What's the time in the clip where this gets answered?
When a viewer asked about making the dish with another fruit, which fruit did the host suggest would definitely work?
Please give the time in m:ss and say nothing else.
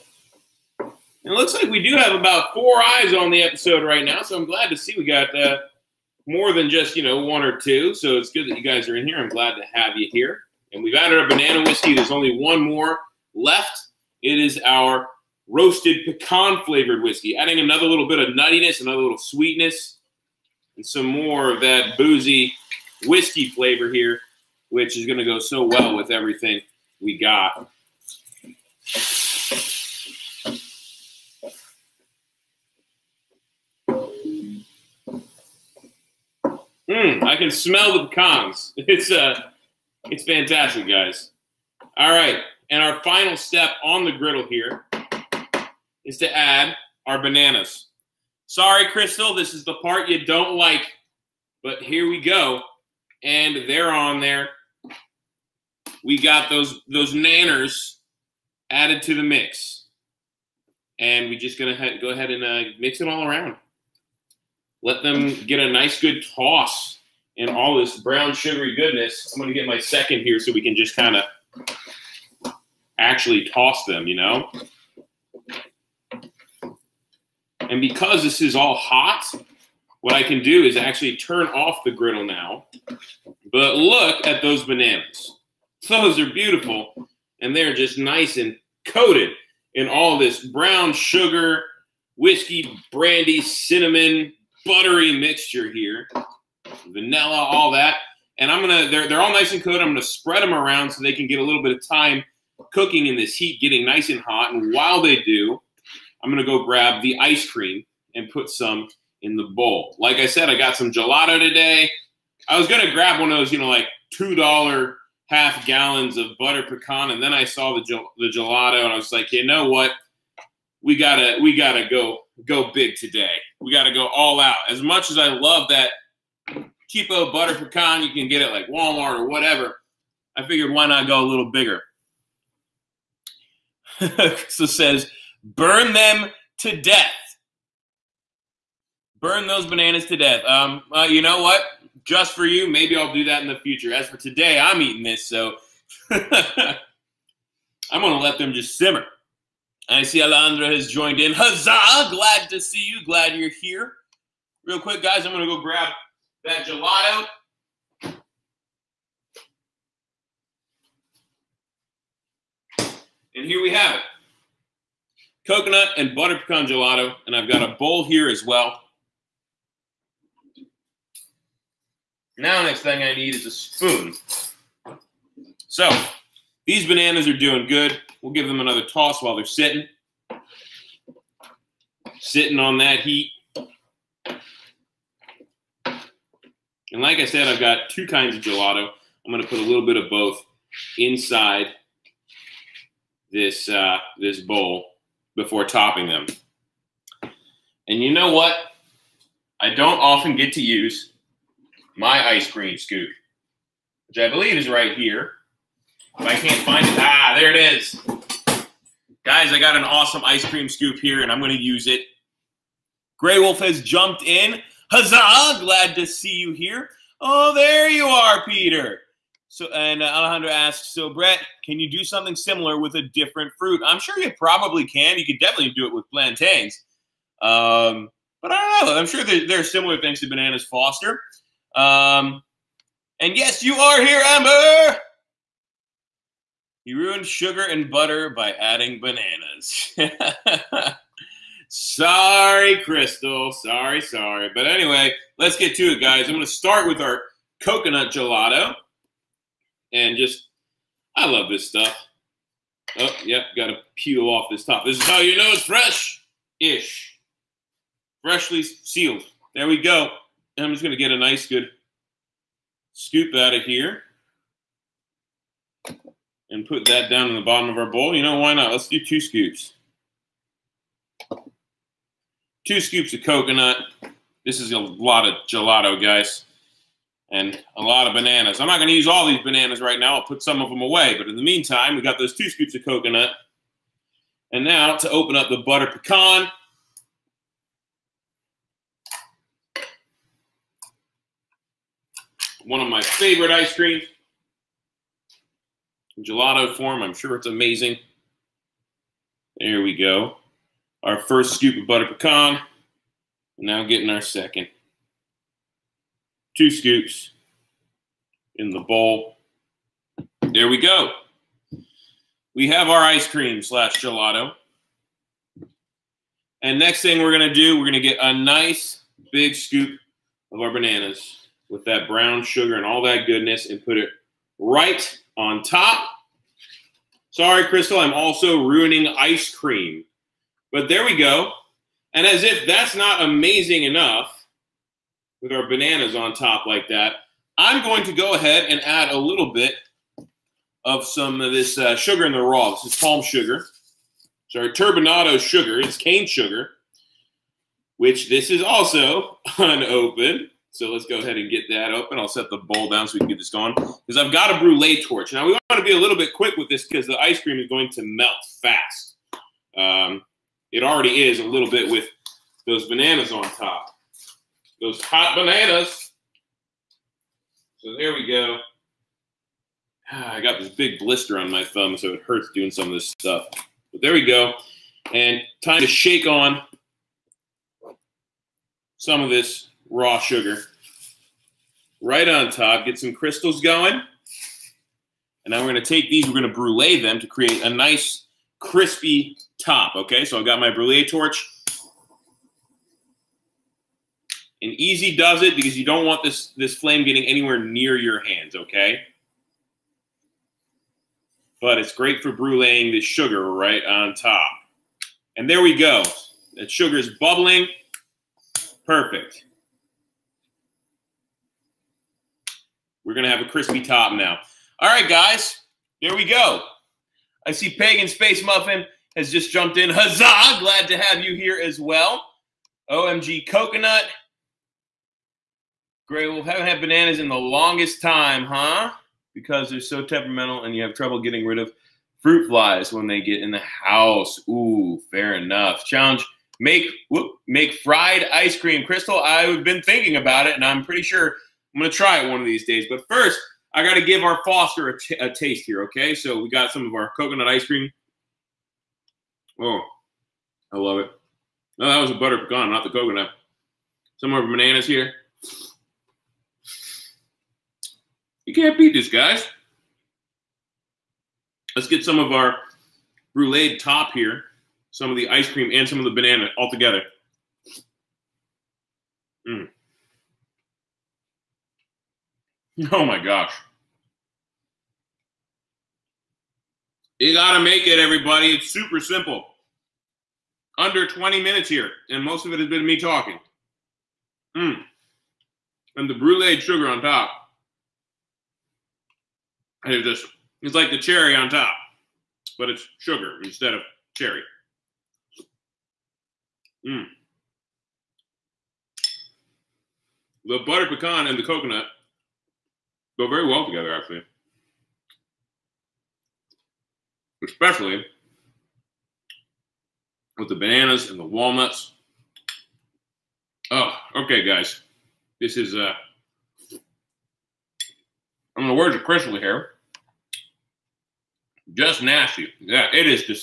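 3:46.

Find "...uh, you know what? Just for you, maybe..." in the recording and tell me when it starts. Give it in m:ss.
2:20.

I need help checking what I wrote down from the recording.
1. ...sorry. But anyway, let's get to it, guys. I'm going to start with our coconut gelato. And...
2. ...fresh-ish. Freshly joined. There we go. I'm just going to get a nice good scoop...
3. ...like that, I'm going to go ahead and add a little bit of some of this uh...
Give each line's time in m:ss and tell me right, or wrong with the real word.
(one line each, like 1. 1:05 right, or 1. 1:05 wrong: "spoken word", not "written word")
1. 4:04 right
2. 4:15 wrong: "sealed", not "joined"
3. 5:36 right.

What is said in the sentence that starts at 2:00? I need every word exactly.
We gotta we gotta go go big today.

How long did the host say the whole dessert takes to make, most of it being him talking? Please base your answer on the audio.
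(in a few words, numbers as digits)
under 20 minutes.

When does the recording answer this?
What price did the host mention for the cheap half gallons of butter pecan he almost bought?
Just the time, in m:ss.
1:54.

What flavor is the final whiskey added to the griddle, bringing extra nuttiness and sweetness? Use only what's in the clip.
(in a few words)
roasted pecan.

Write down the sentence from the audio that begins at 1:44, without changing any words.
And while they do, I'm gonna go grab the ice cream and put some in the bowl.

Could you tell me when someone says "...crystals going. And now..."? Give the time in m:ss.
6:23.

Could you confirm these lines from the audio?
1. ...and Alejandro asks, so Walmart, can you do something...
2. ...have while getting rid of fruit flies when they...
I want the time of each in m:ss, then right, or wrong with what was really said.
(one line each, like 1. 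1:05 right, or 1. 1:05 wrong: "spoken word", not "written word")
1. 3:39 wrong: "Brett", not "Walmart"
2. 7:10 wrong: "trouble", not "while".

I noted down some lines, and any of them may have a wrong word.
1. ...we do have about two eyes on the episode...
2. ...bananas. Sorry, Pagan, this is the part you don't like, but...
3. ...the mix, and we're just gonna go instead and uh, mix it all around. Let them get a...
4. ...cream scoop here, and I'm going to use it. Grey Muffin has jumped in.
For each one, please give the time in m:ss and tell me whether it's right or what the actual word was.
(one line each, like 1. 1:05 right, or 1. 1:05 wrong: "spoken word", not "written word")
1. 0:01 wrong: "four", not "two"
2. 0:47 wrong: "Crystal", not "Pagan"
3. 0:59 wrong: "ahead", not "instead"
4. 3:30 wrong: "Wolf", not "Muffin".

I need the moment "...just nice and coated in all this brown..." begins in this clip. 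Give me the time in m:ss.
1:27.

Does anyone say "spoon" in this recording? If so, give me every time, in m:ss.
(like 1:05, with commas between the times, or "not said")
2:53.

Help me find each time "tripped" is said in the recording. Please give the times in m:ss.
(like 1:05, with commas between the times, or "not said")
not said.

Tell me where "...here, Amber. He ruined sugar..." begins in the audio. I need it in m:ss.
3:54.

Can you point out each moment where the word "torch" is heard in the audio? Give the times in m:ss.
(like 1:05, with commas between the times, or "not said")
5:55, 6:31.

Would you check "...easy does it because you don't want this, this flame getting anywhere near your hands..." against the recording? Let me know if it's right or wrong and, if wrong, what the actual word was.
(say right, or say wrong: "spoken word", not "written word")
right.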